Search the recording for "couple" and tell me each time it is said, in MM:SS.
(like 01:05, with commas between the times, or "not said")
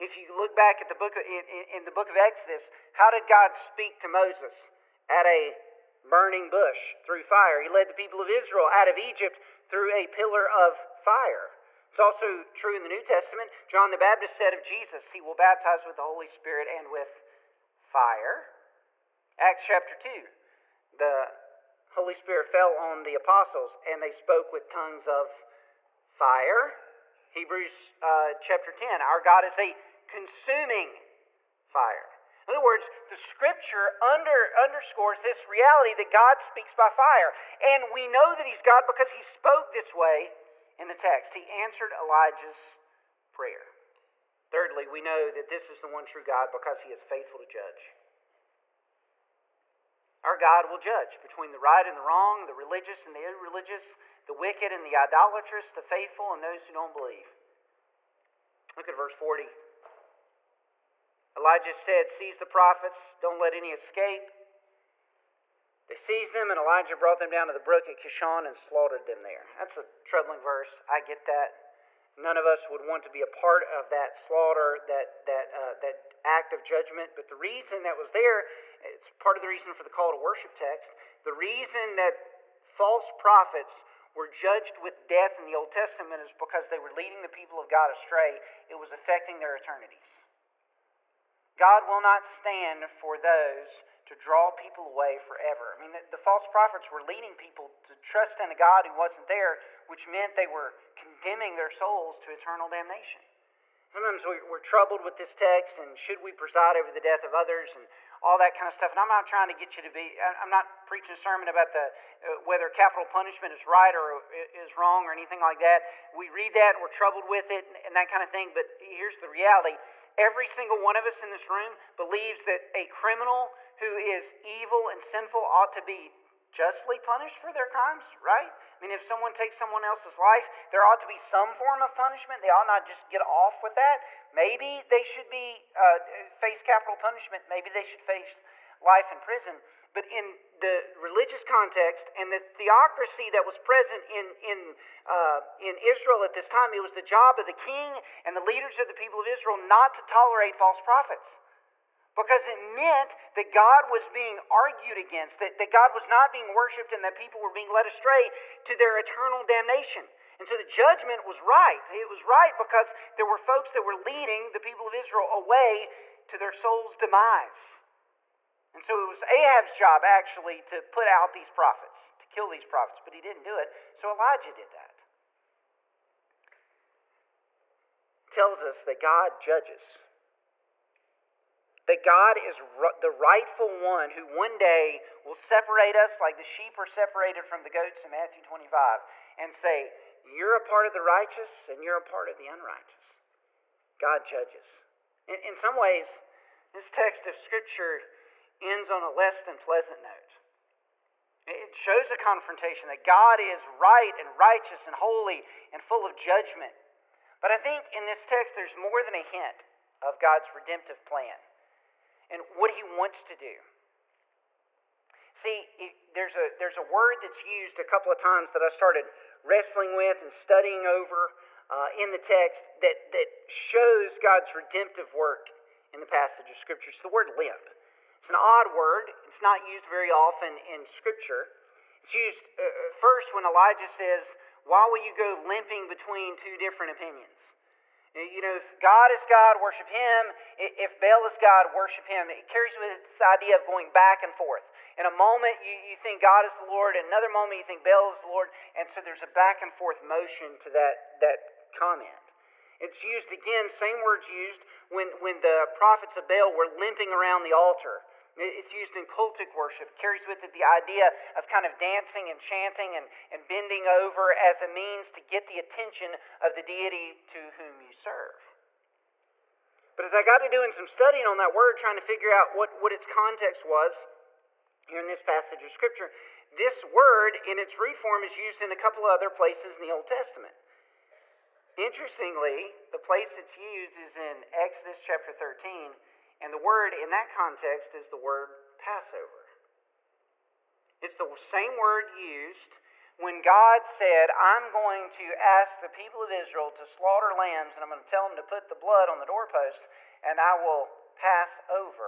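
03:37, 04:38.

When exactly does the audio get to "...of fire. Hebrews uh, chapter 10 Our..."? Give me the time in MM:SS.
00:25.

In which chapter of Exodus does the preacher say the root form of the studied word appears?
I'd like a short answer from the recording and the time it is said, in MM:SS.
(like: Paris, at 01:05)
Exodus 13, at 04:44.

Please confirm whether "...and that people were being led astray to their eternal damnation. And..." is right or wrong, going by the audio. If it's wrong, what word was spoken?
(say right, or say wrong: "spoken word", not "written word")
right.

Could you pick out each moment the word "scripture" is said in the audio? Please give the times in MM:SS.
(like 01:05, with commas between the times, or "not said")
00:33, 03:17, 03:46, 03:50, 04:35.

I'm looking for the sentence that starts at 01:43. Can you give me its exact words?
Sometimes we, are troubled with this text and should we preside over the death of others and all that kind of stuff.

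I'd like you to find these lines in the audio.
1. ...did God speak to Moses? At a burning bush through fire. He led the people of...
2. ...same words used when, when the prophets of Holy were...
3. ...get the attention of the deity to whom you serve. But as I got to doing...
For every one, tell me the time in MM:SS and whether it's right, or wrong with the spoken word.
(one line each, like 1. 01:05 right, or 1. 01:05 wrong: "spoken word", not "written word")
1. 00:03 right
2. 04:13 wrong: "Baal", not "Holy"
3. 04:25 right.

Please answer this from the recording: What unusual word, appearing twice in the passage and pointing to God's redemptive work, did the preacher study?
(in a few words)
Limp.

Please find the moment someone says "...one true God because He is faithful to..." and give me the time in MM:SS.
00:45.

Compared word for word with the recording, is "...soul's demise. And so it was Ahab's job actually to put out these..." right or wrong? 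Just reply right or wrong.
right.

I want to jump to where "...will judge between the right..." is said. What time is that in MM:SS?
00:50.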